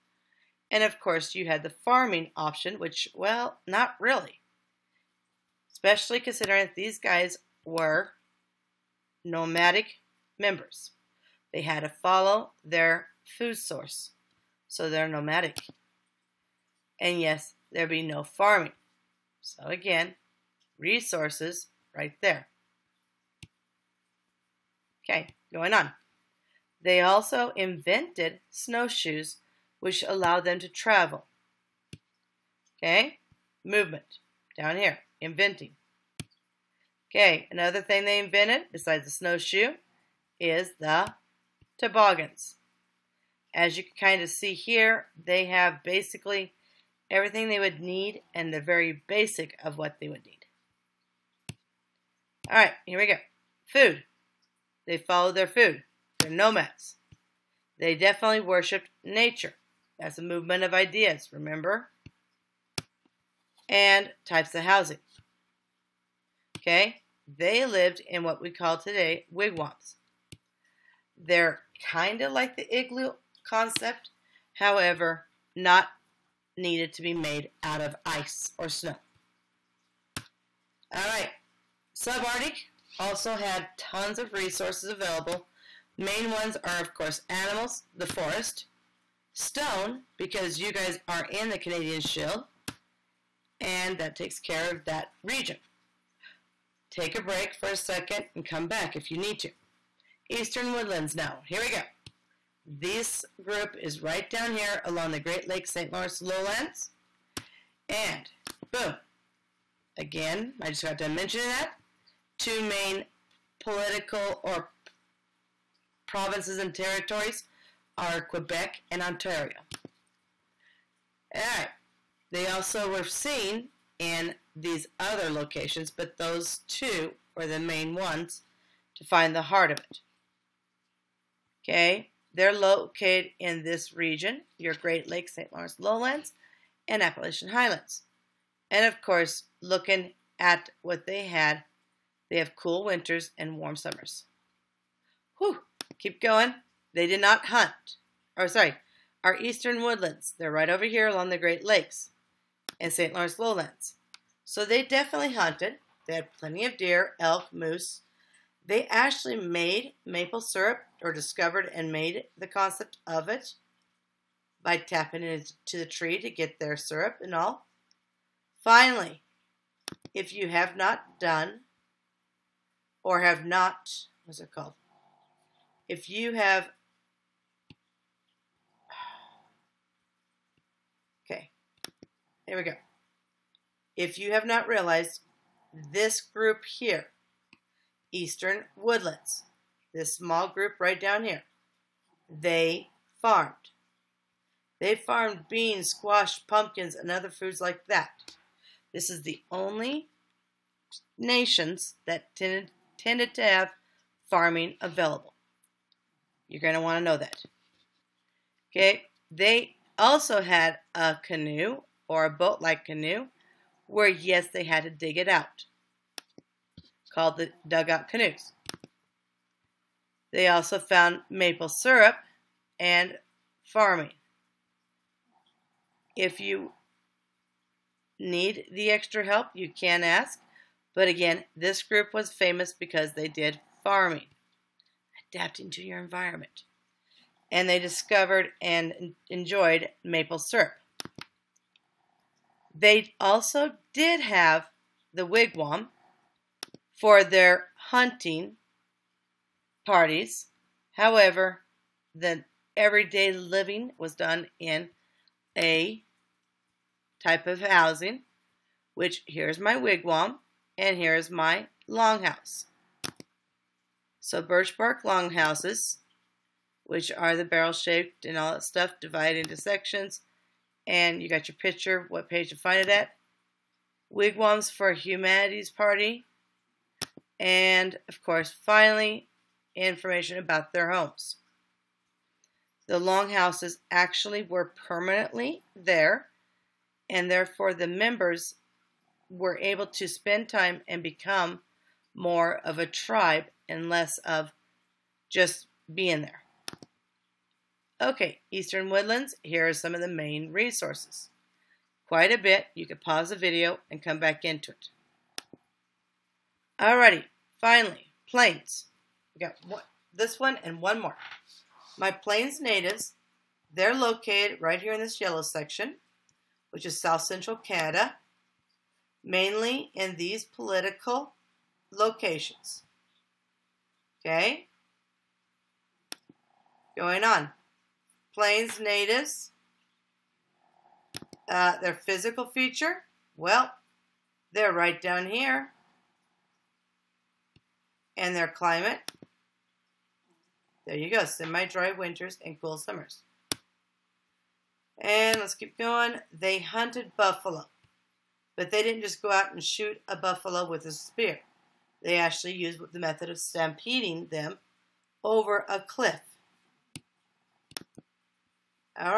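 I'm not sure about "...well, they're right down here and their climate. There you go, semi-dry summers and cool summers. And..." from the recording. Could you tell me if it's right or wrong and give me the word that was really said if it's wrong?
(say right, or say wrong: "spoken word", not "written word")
wrong: "winters", not "summers".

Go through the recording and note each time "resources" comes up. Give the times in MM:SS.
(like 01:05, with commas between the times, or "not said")
00:20, 01:24, 05:00.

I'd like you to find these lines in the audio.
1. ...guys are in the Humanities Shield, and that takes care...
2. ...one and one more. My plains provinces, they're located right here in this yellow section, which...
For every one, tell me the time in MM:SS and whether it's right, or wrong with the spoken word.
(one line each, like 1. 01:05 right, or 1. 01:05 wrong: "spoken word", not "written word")
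1. 01:30 wrong: "Canadian", not "Humanities"
2. 05:10 wrong: "natives", not "provinces".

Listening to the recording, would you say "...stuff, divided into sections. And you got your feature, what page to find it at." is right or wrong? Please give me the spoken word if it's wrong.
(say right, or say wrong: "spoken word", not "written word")
wrong: "picture", not "feature".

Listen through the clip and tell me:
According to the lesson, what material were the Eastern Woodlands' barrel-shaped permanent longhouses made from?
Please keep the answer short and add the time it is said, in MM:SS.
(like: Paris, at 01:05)
birch bark, at 04:24.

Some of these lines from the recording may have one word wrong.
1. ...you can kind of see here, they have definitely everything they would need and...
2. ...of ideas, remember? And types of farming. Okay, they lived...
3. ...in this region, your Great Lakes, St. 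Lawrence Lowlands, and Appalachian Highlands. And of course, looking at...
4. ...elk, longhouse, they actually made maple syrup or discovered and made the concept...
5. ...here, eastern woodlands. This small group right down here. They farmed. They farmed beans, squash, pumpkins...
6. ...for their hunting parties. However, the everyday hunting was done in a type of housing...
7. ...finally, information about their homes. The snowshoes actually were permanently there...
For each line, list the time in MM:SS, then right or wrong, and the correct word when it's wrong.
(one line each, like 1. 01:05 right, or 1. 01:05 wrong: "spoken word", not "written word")
1. 00:43 wrong: "basically", not "definitely"
2. 01:00 wrong: "housing", not "farming"
3. 02:13 right
4. 02:37 wrong: "moose", not "longhouse"
5. 03:06 right
6. 04:07 wrong: "living", not "hunting"
7. 04:38 wrong: "longhouses", not "snowshoes".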